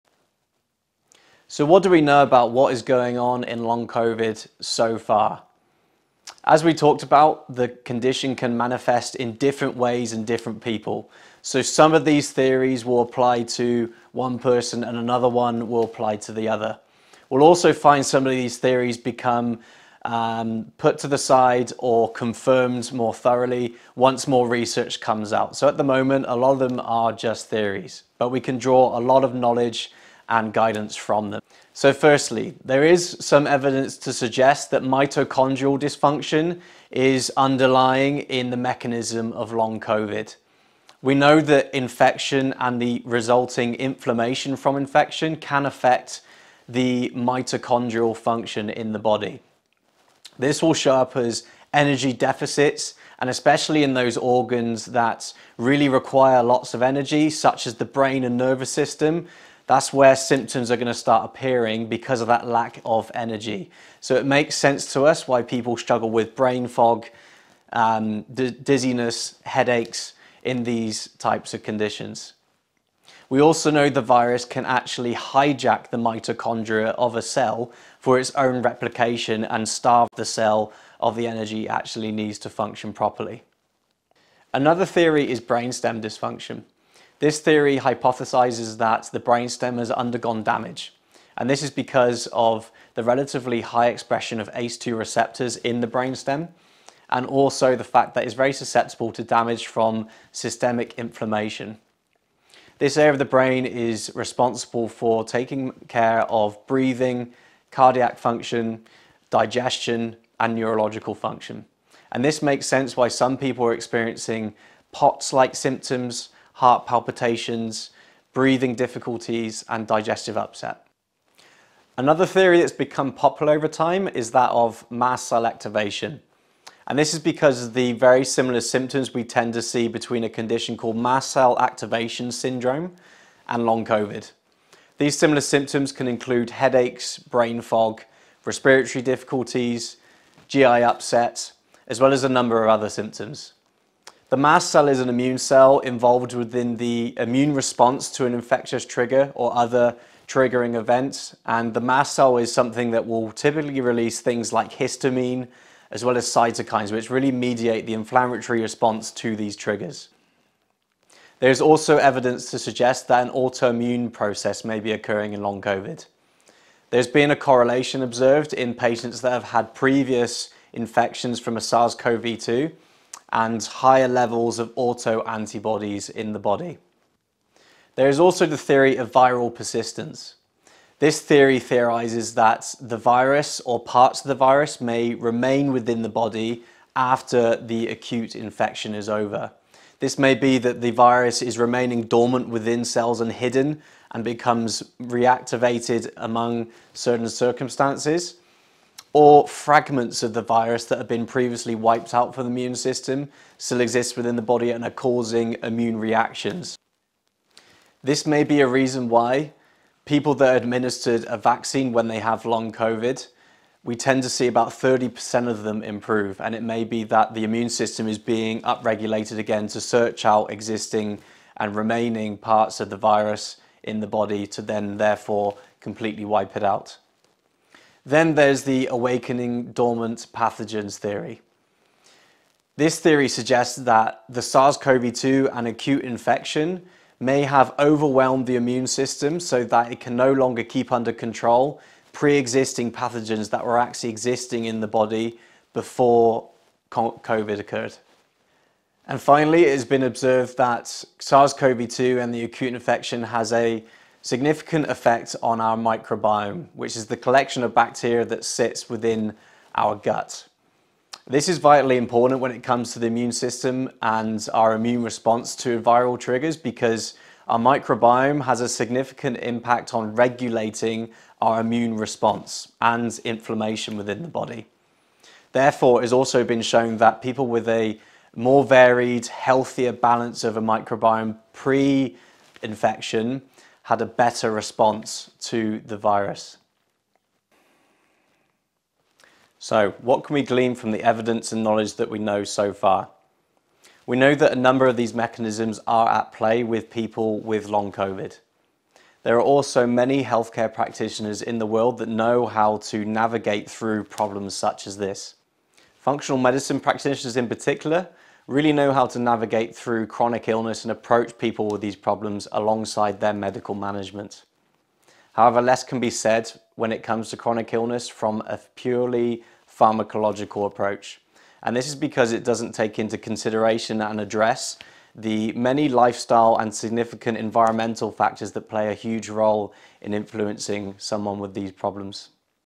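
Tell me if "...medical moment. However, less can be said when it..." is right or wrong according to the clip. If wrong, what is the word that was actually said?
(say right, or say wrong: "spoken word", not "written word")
wrong: "management", not "moment".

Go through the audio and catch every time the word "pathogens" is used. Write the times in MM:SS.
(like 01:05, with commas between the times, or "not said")
03:50, 04:02.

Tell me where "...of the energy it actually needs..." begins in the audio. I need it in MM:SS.
01:20.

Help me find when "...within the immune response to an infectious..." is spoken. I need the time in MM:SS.
02:26.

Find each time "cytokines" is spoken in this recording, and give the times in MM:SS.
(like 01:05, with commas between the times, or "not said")
02:36.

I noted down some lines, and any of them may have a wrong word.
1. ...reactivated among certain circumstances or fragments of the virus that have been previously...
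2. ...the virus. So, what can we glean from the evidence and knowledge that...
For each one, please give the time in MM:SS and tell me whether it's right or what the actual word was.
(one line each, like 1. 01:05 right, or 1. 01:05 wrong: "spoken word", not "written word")
1. 03:15 right
2. 04:45 right.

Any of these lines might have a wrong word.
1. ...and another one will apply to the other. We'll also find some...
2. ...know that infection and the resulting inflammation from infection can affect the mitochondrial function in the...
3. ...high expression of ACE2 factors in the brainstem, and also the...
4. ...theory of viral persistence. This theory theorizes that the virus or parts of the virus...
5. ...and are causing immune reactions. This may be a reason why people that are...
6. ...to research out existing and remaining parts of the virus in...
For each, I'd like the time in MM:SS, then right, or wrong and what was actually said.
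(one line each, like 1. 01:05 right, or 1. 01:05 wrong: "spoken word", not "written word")
1. 00:14 right
2. 00:41 right
3. 01:33 wrong: "receptors", not "factors"
4. 02:58 right
5. 03:24 right
6. 03:39 wrong: "search", not "research".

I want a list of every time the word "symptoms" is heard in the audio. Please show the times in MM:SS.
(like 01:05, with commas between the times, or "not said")
01:00, 01:55, 02:08, 02:15, 02:22.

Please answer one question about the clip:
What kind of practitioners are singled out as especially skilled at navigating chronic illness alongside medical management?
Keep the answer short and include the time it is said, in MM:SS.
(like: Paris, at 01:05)
Functional medicine practitioners, at 05:05.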